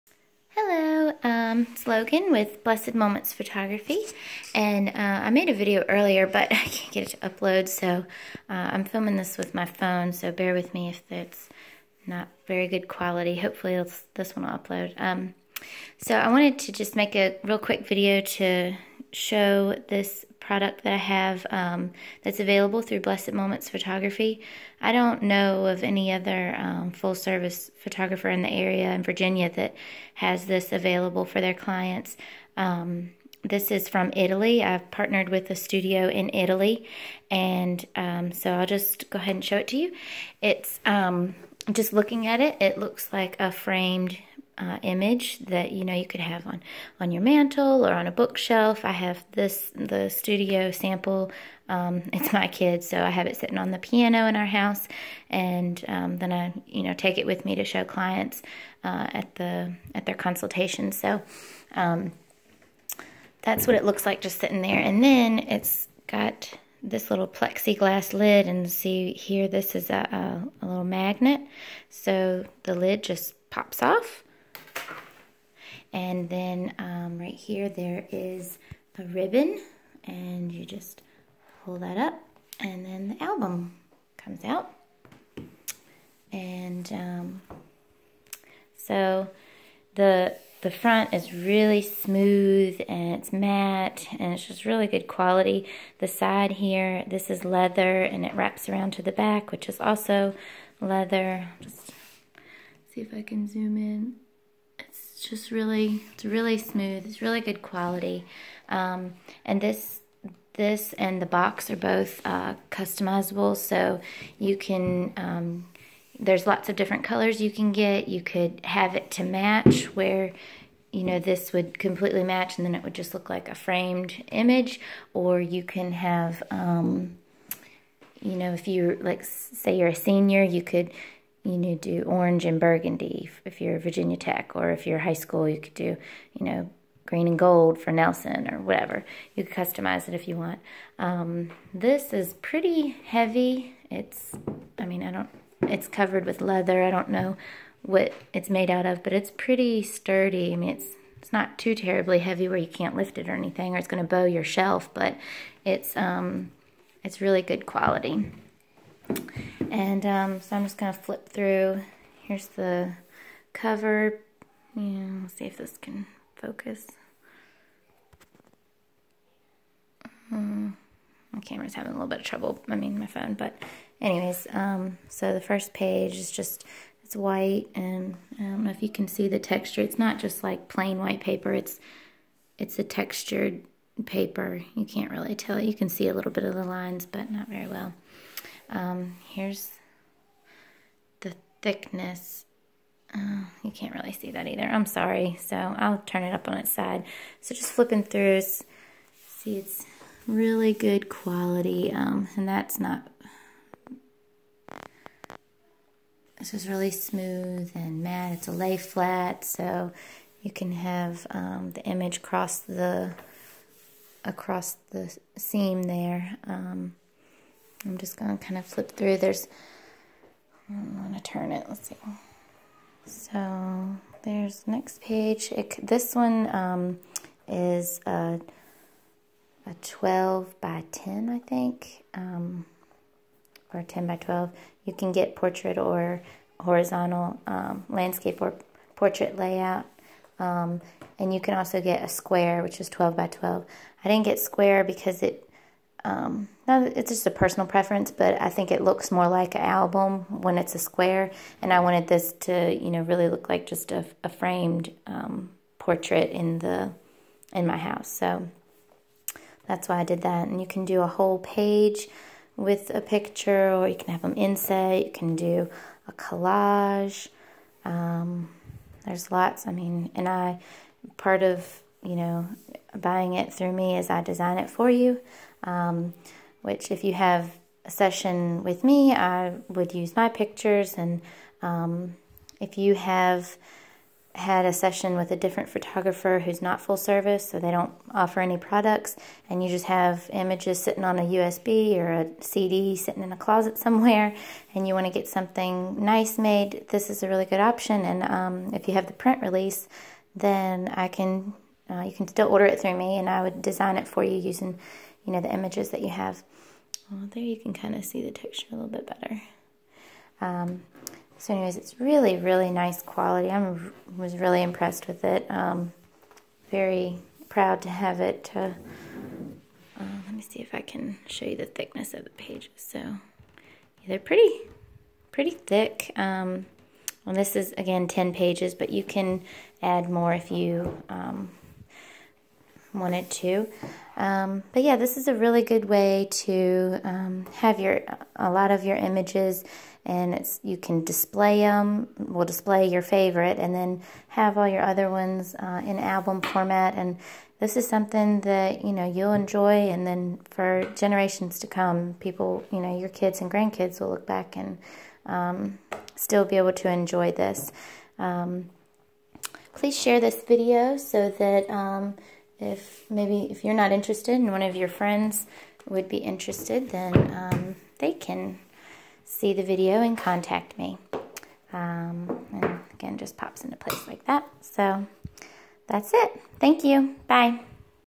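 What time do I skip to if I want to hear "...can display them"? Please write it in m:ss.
5:40.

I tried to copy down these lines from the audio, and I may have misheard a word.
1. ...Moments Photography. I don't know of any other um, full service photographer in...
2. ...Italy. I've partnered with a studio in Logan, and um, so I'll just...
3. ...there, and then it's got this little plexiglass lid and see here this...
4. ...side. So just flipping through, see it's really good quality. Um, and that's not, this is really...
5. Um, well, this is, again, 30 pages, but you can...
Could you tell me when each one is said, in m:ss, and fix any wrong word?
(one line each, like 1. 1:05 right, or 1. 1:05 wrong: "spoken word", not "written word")
1. 0:23 right
2. 0:34 wrong: "Italy", not "Logan"
3. 1:04 right
4. 3:16 right
5. 5:26 wrong: "10", not "30".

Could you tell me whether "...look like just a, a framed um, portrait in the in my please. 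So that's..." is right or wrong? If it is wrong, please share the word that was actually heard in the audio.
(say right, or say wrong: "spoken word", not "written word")
wrong: "house", not "please".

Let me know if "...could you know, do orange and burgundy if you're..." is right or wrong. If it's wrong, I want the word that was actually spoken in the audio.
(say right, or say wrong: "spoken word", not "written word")
right.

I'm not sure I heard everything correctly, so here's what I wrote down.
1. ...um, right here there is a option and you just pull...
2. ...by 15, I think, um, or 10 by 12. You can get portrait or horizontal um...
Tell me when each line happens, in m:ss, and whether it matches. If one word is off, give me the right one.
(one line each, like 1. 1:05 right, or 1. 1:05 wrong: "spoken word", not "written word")
1. 1:16 wrong: "ribbon", not "option"
2. 3:50 wrong: "10", not "15".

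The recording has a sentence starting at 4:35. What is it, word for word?
Um, which, if you have a session with me, I would use my pictures.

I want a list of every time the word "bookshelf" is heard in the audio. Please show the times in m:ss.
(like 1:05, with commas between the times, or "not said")
0:48.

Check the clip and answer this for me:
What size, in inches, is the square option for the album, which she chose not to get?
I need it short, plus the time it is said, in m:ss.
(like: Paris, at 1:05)
12 by 12, at 4:02.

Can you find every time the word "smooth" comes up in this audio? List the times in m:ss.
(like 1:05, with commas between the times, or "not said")
1:31, 1:46, 3:26.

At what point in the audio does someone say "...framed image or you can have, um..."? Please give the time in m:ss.
2:03.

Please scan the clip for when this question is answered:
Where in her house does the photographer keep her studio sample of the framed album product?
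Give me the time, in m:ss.
0:53.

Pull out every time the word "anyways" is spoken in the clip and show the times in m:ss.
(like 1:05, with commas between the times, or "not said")
2:53, 5:11.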